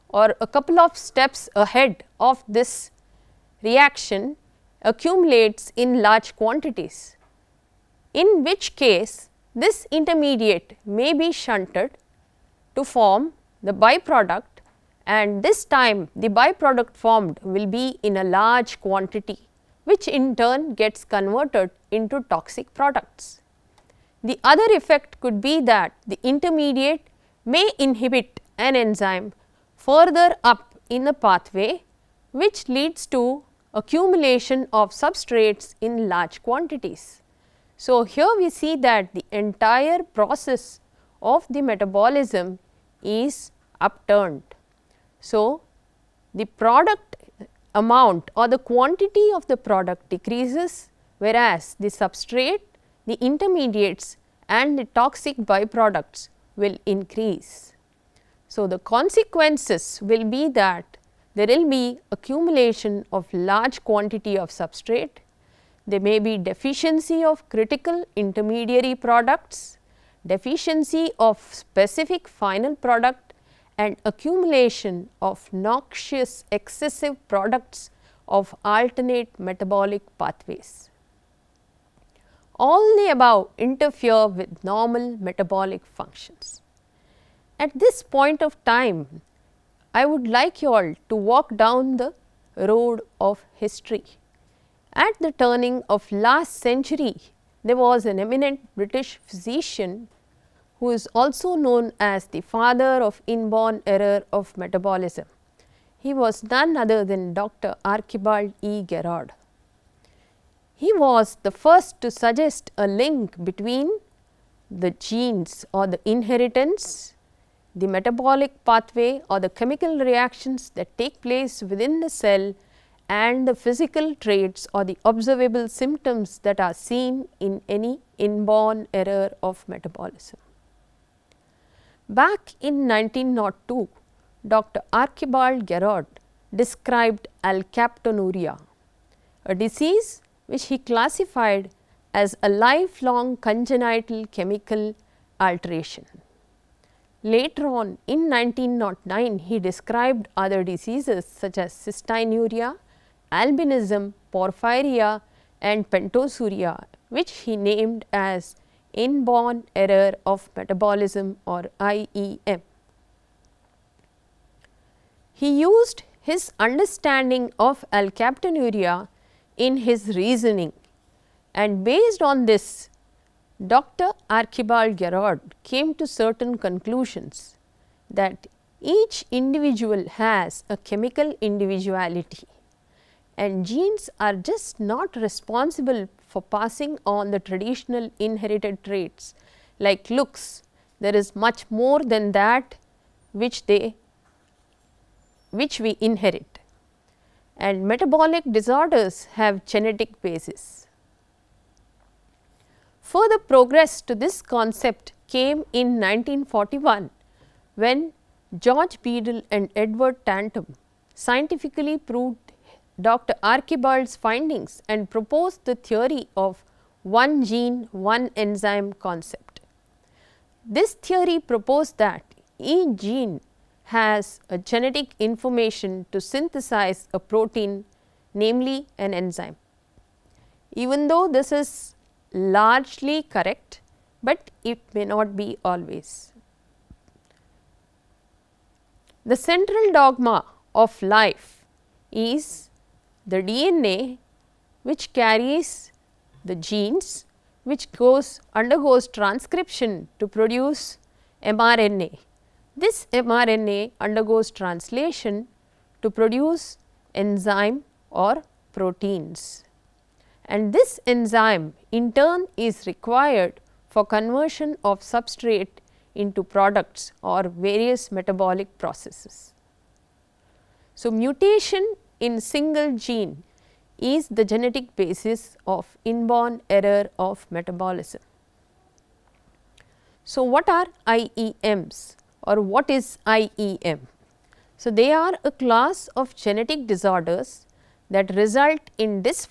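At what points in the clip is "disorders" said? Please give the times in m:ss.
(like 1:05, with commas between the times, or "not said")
3:18, 4:46.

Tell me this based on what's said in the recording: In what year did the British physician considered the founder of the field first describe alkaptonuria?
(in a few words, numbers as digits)
1902.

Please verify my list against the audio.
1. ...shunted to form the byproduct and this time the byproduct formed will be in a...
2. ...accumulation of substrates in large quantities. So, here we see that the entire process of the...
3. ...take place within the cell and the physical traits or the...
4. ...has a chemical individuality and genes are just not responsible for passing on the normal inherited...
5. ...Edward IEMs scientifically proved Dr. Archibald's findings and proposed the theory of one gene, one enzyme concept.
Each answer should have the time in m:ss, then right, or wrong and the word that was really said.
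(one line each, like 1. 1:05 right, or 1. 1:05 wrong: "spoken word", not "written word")
1. 0:11 right
2. 0:33 right
3. 2:00 right
4. 3:00 wrong: "traditional", not "normal"
5. 3:29 wrong: "Tatum", not "IEMs".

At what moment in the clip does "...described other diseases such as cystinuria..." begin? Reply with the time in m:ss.
2:29.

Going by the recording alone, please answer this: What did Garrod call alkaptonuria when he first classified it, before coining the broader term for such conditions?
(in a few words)
lifelong congenital chemical alteration.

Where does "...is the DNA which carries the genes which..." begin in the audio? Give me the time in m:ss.
4:02.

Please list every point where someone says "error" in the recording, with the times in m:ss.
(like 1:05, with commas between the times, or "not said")
1:43, 2:08, 2:39, 4:36.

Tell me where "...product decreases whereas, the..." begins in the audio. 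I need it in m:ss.
0:49.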